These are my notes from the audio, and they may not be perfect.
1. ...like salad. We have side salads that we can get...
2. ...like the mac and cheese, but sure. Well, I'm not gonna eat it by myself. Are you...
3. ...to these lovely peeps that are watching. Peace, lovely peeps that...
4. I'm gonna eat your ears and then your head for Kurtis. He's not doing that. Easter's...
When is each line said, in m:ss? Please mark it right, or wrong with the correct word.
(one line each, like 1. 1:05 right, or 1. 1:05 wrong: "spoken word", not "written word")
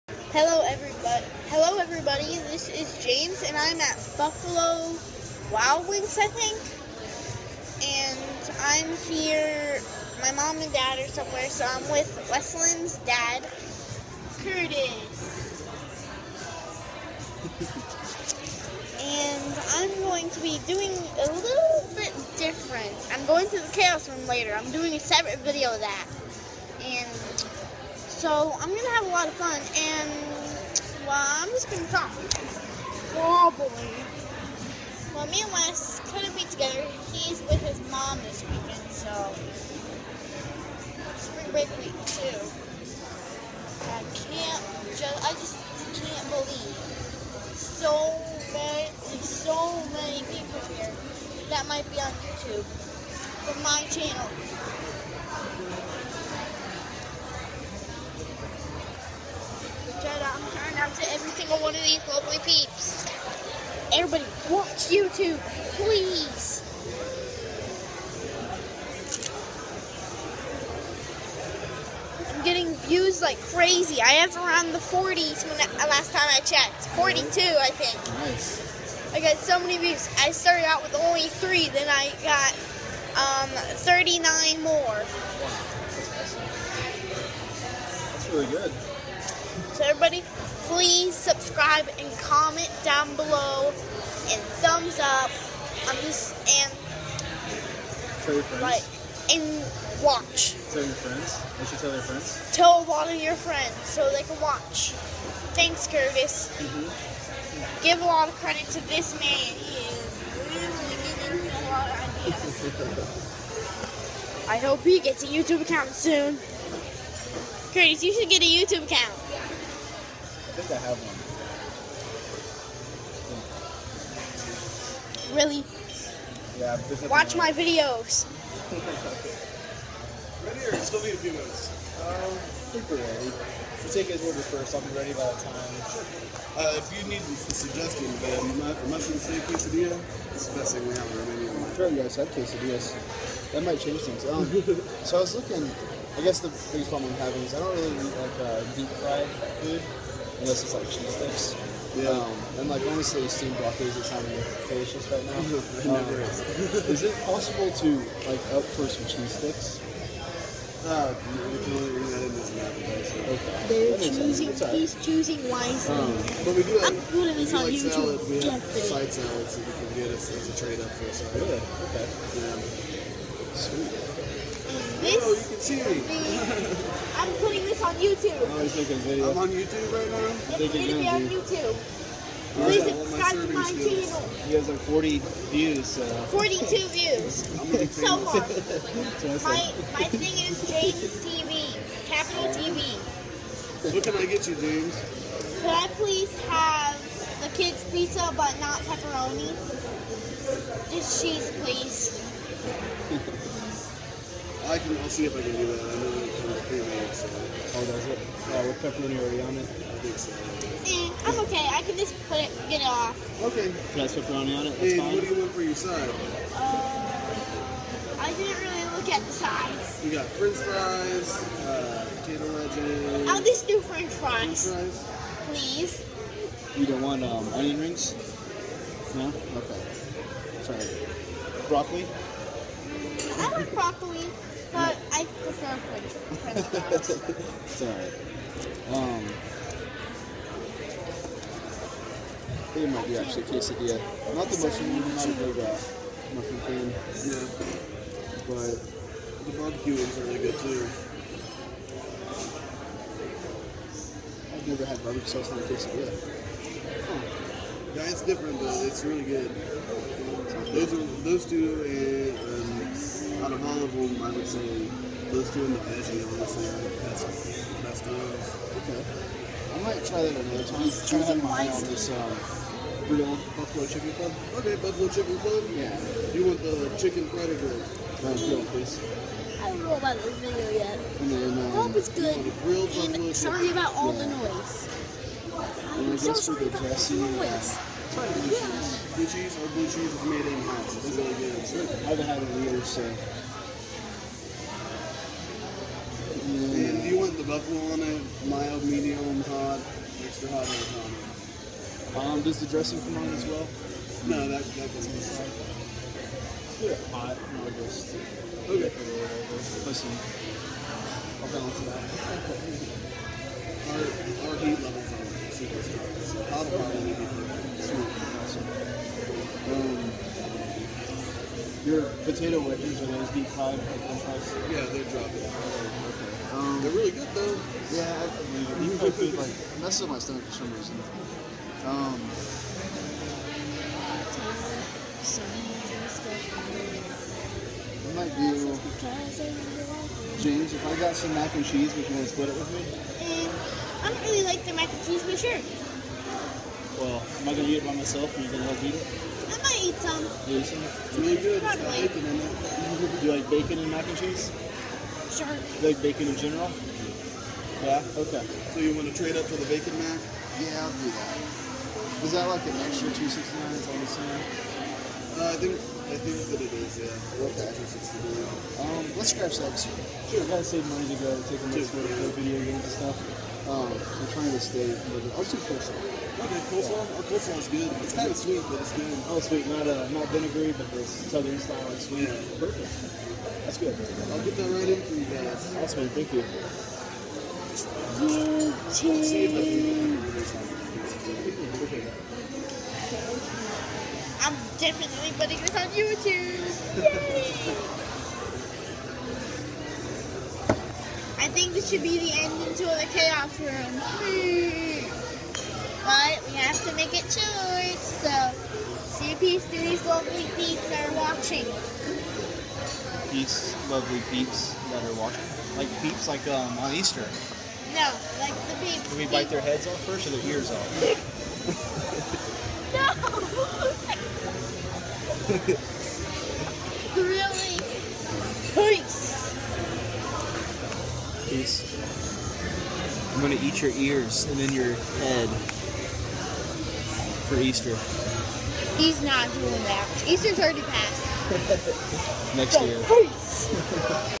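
1. 2:47 right
2. 5:44 right
3. 6:49 right
4. 7:13 wrong: "Easter", not "Kurtis".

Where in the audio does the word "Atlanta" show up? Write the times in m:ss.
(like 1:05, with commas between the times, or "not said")
not said.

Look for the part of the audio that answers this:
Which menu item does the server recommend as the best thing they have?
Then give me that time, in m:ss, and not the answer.
2:18.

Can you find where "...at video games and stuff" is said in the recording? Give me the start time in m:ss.
6:12.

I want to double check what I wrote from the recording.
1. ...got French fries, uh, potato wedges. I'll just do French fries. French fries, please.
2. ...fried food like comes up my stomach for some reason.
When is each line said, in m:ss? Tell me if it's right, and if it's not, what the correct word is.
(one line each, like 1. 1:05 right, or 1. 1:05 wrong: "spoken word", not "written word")
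1. 3:40 right
2. 5:28 wrong: "messes", not "comes".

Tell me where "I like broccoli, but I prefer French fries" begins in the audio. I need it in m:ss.
3:53.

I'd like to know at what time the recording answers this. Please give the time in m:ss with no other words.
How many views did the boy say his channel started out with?
1:21.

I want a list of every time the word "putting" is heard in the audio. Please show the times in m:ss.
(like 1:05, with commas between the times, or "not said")
2:57, 6:35.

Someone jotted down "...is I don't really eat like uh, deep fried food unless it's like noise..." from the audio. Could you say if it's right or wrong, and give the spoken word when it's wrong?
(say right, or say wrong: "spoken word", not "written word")
wrong: "cheese", not "noise".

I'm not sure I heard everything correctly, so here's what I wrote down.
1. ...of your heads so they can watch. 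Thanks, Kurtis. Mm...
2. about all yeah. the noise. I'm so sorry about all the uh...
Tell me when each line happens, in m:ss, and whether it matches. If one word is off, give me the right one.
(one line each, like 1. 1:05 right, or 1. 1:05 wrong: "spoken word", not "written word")
1. 1:43 wrong: "friends", not "heads"
2. 4:43 right.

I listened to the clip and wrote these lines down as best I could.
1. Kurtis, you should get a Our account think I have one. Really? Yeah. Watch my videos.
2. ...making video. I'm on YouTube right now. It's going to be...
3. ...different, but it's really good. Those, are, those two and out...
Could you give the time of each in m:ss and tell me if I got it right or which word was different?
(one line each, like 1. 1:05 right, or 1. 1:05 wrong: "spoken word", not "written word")
1. 1:57 wrong: "YouTube", not "Our"
2. 2:58 right
3. 4:18 right.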